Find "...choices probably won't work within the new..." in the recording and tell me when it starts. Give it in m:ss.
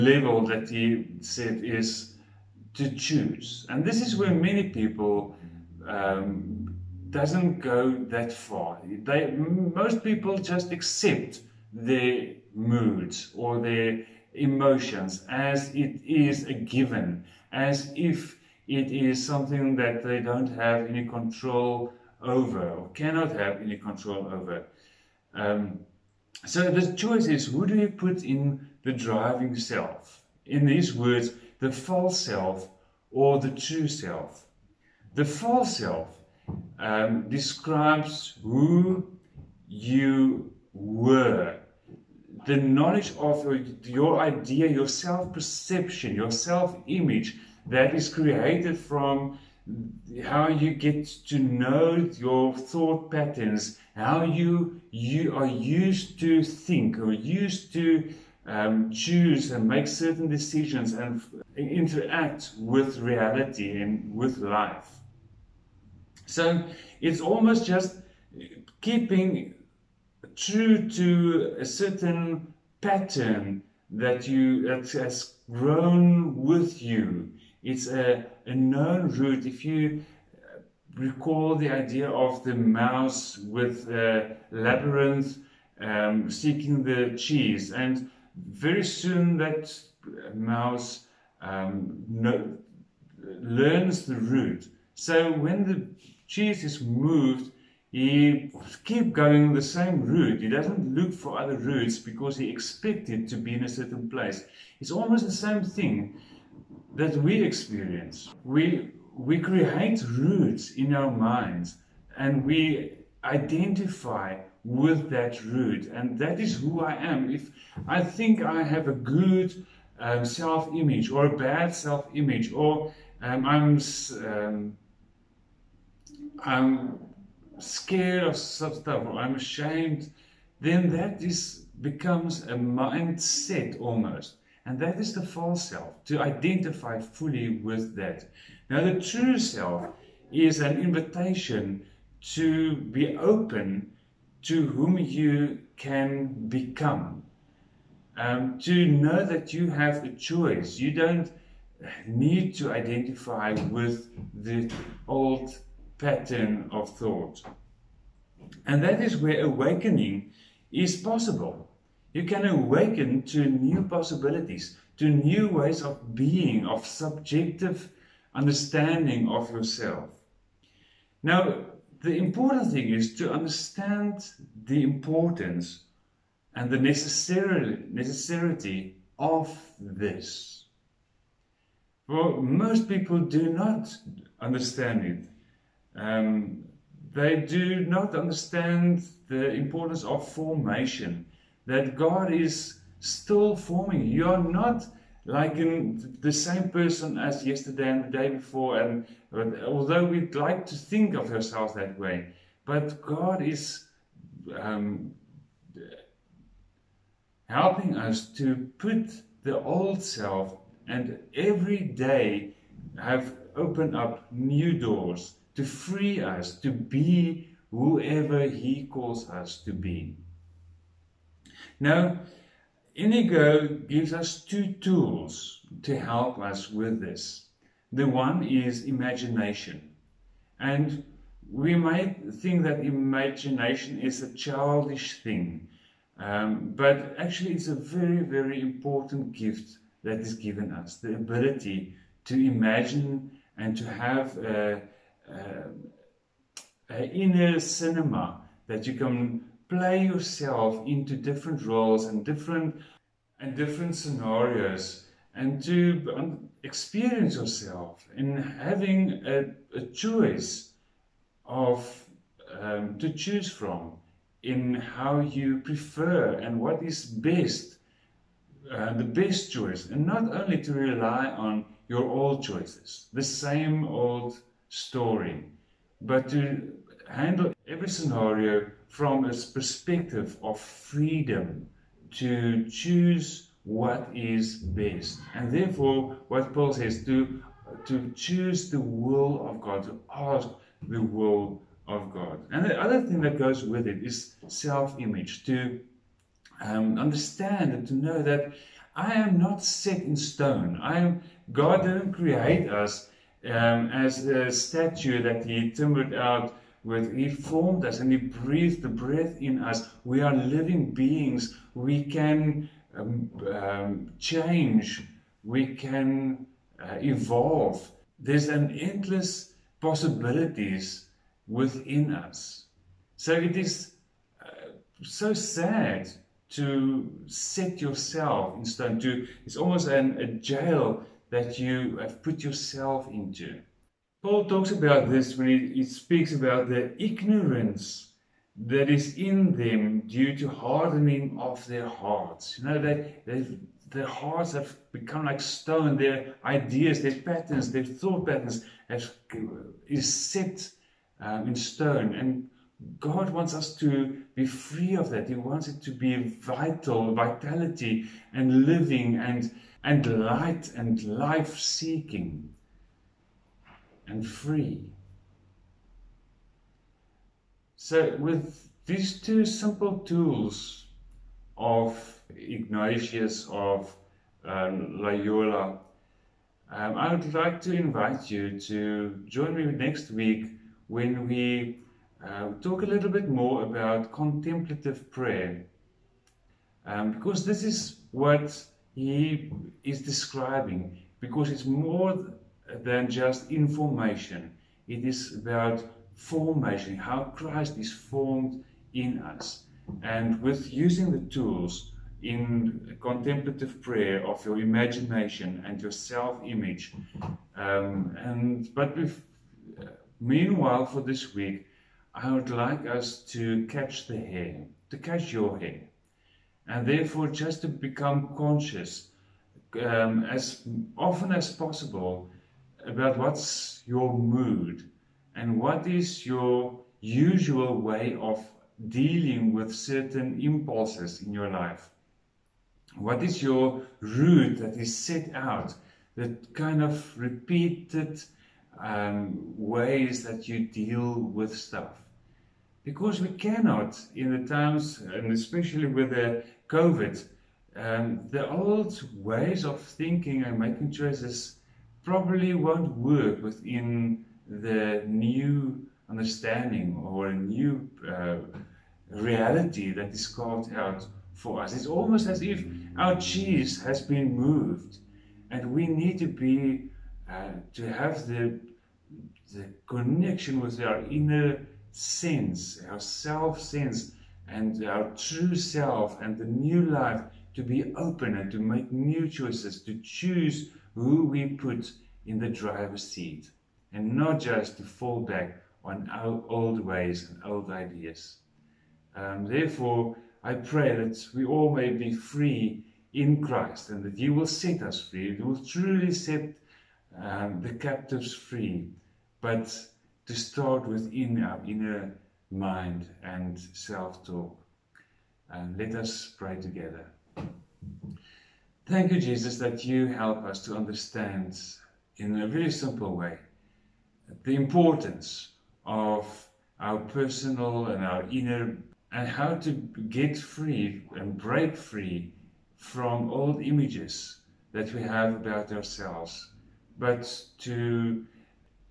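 7:30.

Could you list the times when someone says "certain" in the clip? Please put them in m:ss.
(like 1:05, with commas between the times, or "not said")
0:59, 1:11, 1:43, 7:09.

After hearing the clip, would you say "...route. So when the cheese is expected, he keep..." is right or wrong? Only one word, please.
wrong.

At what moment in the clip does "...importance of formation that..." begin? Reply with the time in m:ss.
3:09.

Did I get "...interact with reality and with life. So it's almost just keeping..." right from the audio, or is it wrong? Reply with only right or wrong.
right.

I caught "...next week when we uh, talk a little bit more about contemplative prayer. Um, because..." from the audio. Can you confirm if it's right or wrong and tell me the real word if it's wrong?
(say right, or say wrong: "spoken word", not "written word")
right.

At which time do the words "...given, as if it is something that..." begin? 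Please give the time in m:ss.
0:16.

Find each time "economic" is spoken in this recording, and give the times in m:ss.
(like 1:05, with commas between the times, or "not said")
not said.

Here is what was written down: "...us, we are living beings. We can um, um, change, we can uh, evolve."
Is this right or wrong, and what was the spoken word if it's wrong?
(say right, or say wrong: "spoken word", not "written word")
right.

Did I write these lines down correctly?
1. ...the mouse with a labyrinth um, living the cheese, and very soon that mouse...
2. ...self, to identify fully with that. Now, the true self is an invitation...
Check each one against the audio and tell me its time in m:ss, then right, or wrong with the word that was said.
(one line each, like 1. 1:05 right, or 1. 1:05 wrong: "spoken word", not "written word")
1. 1:22 wrong: "seeking", not "living"
2. 2:15 right.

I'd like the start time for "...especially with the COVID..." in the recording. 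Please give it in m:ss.
7:25.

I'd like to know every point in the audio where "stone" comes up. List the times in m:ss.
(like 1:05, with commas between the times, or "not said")
5:00, 5:28, 5:45, 5:51.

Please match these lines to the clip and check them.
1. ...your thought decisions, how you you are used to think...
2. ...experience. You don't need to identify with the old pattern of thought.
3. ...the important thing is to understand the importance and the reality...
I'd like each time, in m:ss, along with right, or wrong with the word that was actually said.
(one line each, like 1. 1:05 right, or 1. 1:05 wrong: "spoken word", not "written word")
1. 0:52 wrong: "patterns", not "decisions"
2. 2:30 wrong: "choice", not "experience"
3. 2:52 wrong: "necessity", not "reality".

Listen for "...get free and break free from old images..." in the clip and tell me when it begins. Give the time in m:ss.
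8:40.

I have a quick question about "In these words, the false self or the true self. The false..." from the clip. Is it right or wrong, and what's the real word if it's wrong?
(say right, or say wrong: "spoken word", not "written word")
right.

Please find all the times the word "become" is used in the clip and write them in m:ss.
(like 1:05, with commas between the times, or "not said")
2:11, 2:26, 5:44, 6:57.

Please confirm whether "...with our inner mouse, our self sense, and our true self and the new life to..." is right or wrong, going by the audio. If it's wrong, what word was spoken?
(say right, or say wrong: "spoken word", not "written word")
wrong: "sense", not "mouse".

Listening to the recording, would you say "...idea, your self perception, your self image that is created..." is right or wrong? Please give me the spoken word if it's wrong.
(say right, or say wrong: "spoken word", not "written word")
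right.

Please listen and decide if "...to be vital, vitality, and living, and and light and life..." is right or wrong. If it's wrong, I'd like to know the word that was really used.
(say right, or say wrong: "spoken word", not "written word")
right.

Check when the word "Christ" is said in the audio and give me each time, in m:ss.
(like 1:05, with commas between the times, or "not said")
6:37, 8:13.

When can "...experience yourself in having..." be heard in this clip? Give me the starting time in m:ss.
4:16.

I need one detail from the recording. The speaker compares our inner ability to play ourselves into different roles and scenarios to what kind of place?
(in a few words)
Inner cinema.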